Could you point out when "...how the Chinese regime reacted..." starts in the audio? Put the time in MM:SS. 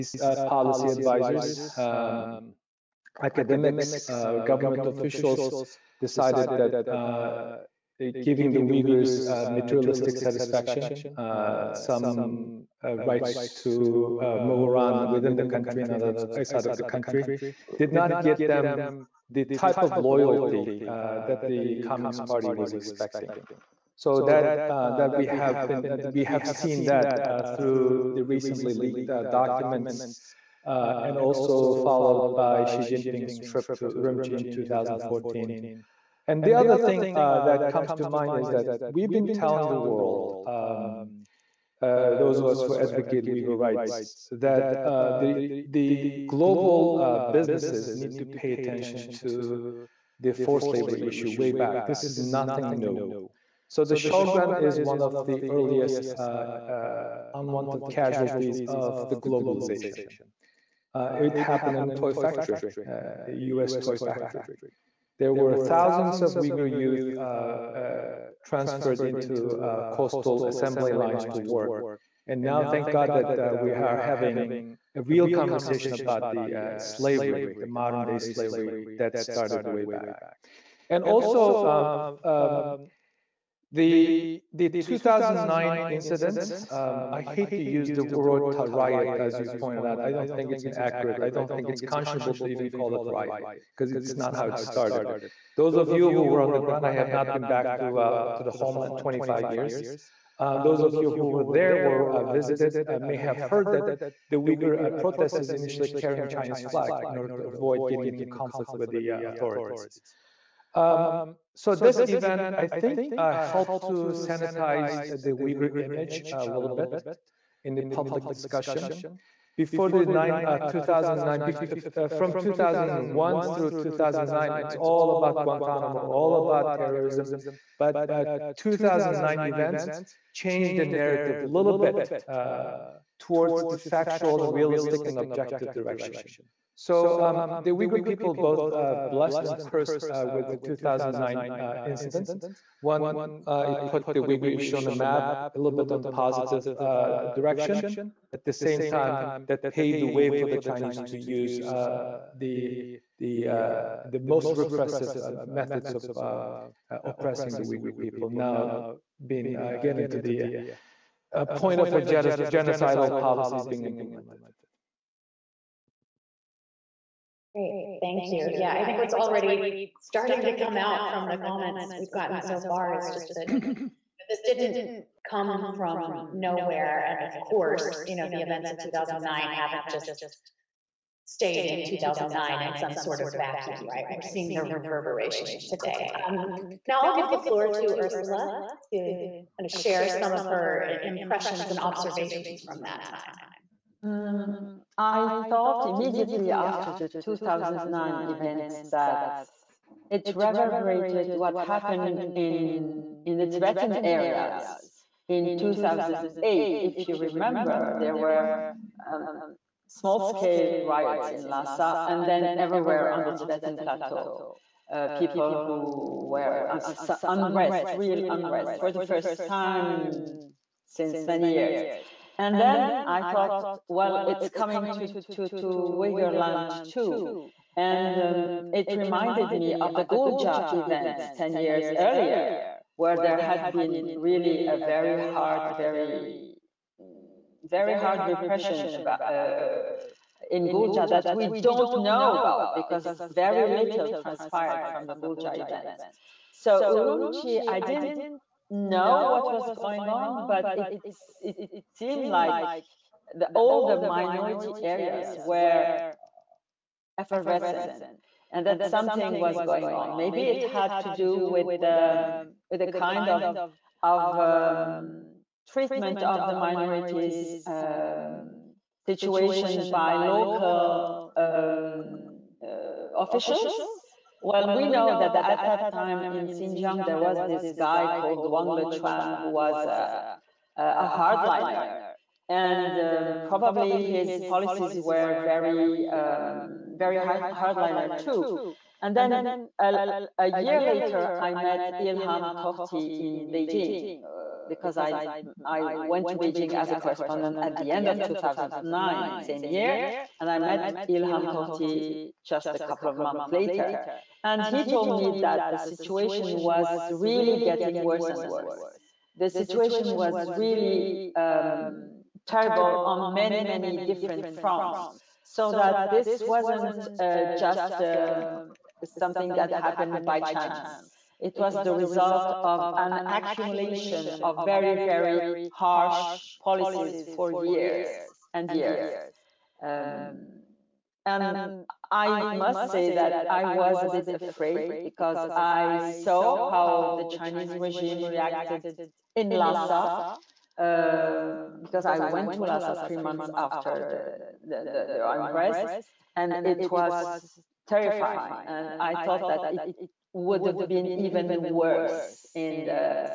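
05:36.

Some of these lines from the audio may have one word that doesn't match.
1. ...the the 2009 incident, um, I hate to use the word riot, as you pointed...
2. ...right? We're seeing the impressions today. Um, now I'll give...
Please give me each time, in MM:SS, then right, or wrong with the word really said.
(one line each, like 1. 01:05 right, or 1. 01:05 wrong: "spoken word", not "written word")
1. 01:23 right
2. 03:03 wrong: "reverberations", not "impressions".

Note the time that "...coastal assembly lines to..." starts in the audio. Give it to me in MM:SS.
01:09.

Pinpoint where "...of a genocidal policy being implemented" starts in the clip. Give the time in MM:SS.
02:41.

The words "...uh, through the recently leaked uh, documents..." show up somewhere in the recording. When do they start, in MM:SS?
00:27.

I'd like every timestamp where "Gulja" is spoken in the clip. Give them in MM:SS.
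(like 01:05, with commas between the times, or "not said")
03:50, 04:00, 04:05.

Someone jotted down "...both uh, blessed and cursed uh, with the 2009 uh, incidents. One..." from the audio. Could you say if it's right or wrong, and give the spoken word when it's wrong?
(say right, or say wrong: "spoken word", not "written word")
right.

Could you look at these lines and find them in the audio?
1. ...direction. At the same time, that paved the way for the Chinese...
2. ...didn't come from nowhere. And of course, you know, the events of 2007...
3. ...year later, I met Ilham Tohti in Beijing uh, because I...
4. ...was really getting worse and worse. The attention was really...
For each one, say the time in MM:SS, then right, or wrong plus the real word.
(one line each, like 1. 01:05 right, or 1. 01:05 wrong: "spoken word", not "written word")
1. 02:27 right
2. 02:54 wrong: "2009", not "2007"
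3. 04:50 right
4. 05:06 wrong: "situation", not "attention".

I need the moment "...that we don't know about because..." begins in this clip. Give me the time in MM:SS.
04:01.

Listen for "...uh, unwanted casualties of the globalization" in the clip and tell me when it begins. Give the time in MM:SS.
00:56.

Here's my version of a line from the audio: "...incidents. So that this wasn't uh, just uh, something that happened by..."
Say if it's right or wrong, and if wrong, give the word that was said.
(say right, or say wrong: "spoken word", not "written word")
wrong: "fronts", not "incidents".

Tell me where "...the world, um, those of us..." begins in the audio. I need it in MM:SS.
00:39.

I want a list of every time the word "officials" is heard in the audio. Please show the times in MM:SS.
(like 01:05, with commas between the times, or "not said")
00:04, 04:33.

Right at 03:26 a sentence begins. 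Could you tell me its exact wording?
If you remember, there were um, small-scale riots in Lhasa and then everywhere on the Tibetan plateau.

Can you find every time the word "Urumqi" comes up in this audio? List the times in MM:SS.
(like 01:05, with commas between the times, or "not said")
00:33, 04:06.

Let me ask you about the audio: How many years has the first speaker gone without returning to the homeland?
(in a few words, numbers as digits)
25.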